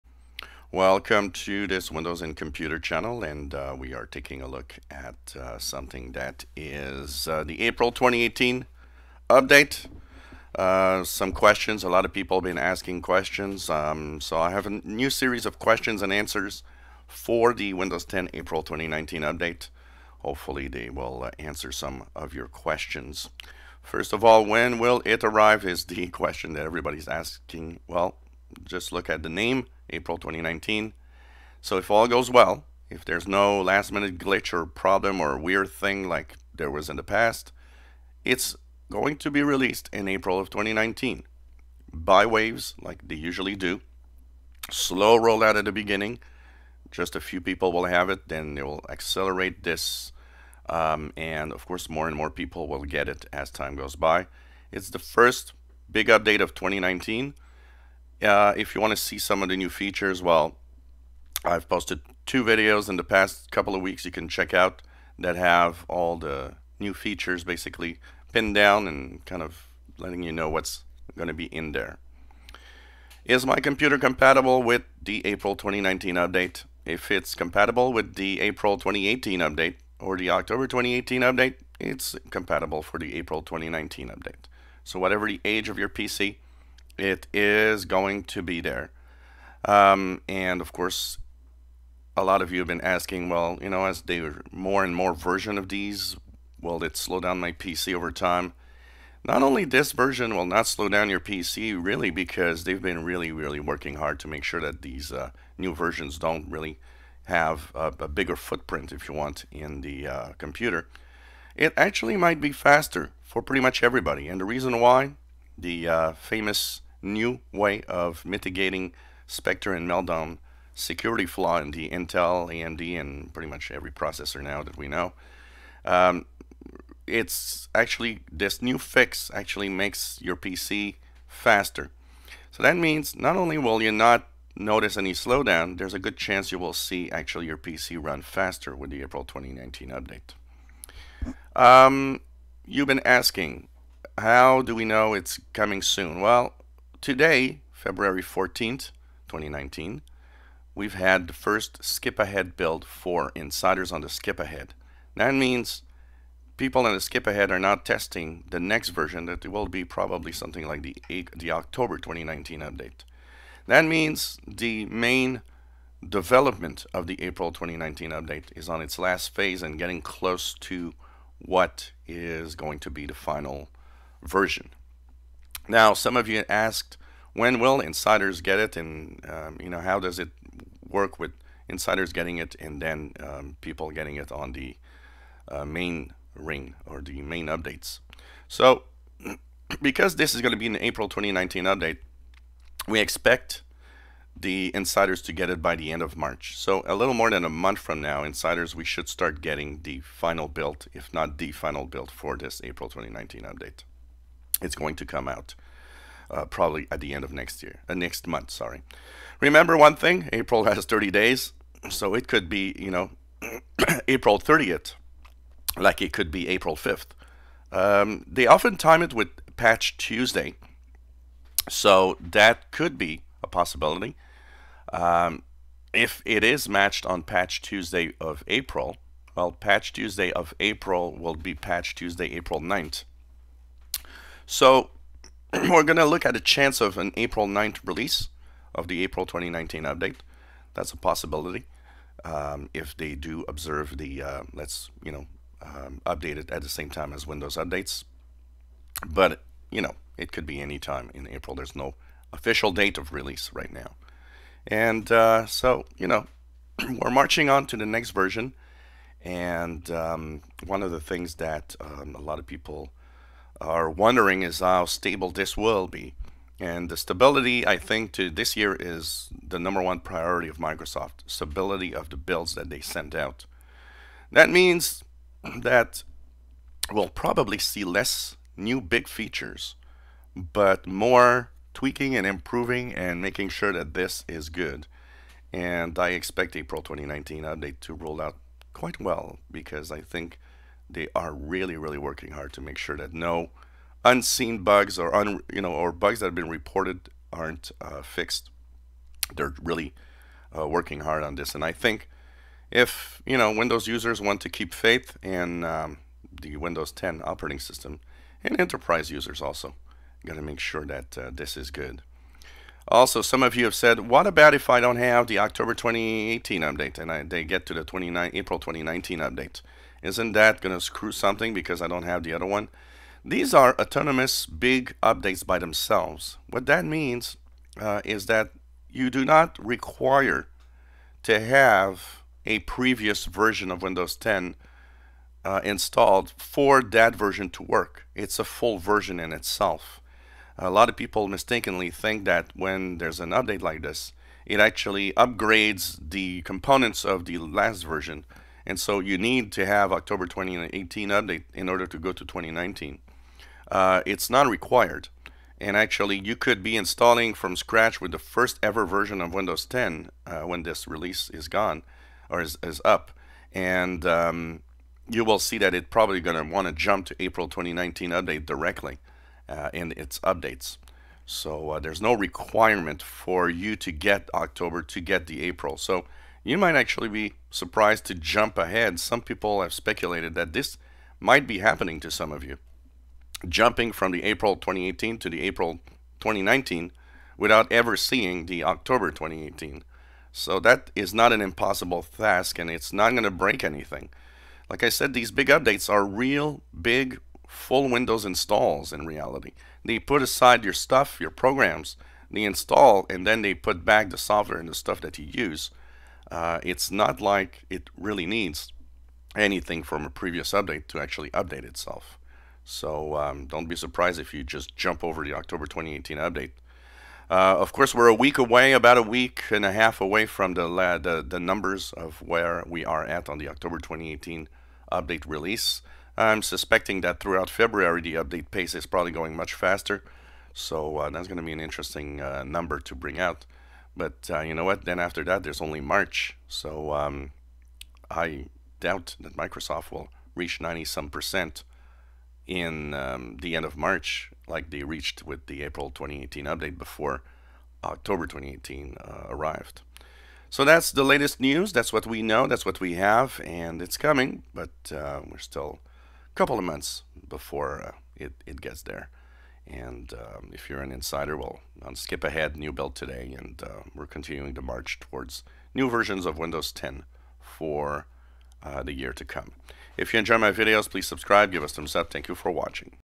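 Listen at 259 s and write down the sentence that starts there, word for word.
And um, one of the things that um, a lot of people are wondering is how stable this will be.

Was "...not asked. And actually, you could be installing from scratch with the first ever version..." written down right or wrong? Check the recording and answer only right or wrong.
wrong.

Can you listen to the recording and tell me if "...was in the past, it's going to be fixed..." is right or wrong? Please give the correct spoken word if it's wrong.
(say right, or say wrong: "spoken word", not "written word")
wrong: "released", not "fixed".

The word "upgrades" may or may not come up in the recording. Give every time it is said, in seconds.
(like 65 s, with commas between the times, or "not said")
345 s.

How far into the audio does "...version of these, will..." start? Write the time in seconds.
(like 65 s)
95 s.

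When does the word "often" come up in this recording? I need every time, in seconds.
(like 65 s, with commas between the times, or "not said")
218 s.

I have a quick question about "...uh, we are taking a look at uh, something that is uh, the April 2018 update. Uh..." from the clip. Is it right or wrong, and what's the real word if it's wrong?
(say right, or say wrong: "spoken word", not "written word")
right.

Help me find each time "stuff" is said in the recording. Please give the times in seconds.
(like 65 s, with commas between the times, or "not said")
400 s, 404 s.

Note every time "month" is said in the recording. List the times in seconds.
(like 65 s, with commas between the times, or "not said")
197 s, 208 s, 456 s.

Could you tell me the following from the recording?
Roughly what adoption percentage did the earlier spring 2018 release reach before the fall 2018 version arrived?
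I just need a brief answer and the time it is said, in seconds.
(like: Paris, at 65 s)
90 some percent, at 440 s.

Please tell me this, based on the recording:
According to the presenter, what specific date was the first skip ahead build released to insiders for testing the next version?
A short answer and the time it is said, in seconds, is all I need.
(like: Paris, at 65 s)
February 14th, 2019, at 147 s.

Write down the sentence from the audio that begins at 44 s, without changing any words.
Slow rollout at the beginning, just a few people will have it, then they will accelerate this.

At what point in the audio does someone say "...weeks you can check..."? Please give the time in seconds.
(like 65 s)
63 s.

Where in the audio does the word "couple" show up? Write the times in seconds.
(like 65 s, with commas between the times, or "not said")
63 s, 456 s.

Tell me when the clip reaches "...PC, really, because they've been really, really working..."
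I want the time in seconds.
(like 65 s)
101 s.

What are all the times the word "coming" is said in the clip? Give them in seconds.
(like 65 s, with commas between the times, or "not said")
145 s, 453 s.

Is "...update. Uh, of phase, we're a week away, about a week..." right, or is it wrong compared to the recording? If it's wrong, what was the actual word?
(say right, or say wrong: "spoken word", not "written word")
wrong: "course", not "phase".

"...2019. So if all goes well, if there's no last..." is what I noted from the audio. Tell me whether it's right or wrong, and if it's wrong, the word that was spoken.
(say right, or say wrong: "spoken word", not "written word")
right.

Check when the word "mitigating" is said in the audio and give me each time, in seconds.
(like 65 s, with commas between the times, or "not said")
118 s.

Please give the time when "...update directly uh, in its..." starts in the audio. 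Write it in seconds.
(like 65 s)
368 s.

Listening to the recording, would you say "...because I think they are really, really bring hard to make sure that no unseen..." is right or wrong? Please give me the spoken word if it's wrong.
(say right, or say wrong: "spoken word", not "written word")
wrong: "working", not "bring".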